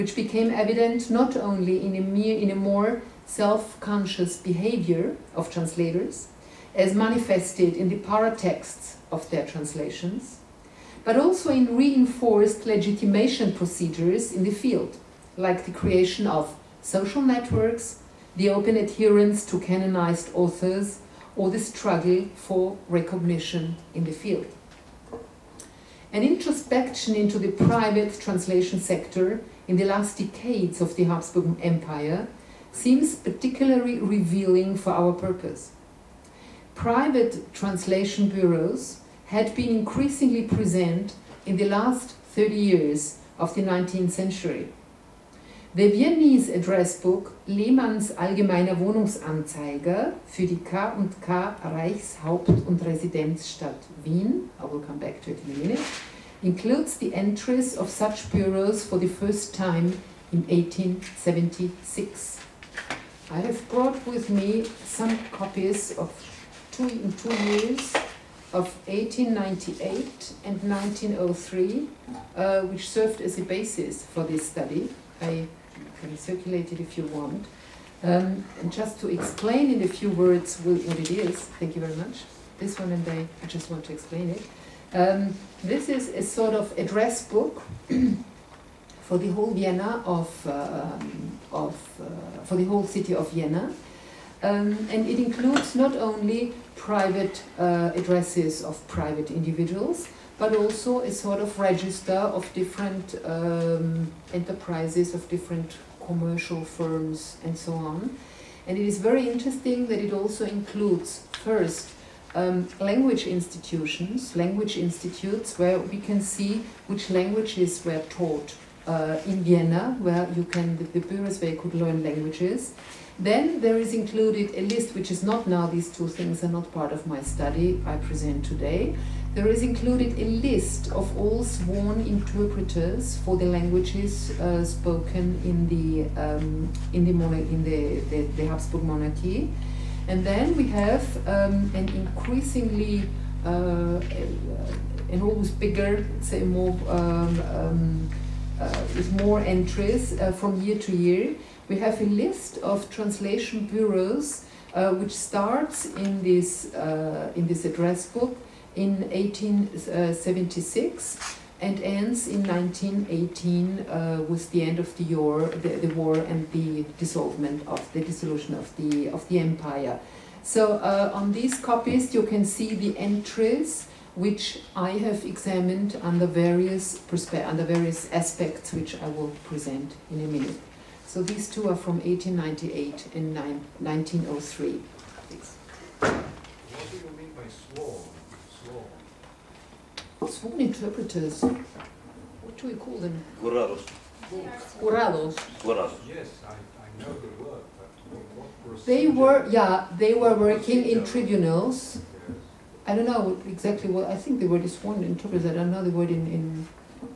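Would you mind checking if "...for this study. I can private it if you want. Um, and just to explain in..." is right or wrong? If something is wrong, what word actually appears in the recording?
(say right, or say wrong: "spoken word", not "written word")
wrong: "circulate", not "private".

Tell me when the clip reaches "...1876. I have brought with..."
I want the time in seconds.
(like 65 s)
60 s.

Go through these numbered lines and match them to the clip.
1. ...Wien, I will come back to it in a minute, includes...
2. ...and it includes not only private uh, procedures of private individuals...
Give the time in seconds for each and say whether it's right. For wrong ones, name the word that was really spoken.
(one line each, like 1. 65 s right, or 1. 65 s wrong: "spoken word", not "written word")
1. 54 s right
2. 94 s wrong: "addresses", not "procedures".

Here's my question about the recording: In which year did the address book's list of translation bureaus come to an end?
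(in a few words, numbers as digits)
1918.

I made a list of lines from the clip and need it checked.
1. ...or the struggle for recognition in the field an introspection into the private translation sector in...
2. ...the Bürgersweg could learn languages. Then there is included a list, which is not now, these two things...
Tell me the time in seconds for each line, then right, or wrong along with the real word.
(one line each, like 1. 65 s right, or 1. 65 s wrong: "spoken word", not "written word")
1. 21 s right
2. 120 s right.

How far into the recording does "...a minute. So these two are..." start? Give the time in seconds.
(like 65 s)
180 s.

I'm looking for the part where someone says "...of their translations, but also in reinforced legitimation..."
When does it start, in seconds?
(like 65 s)
9 s.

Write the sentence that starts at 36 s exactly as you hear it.
Private translation bureaus had been increasingly present in the last 30 years of the 19th century.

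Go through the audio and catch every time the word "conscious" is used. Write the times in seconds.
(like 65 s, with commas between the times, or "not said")
3 s.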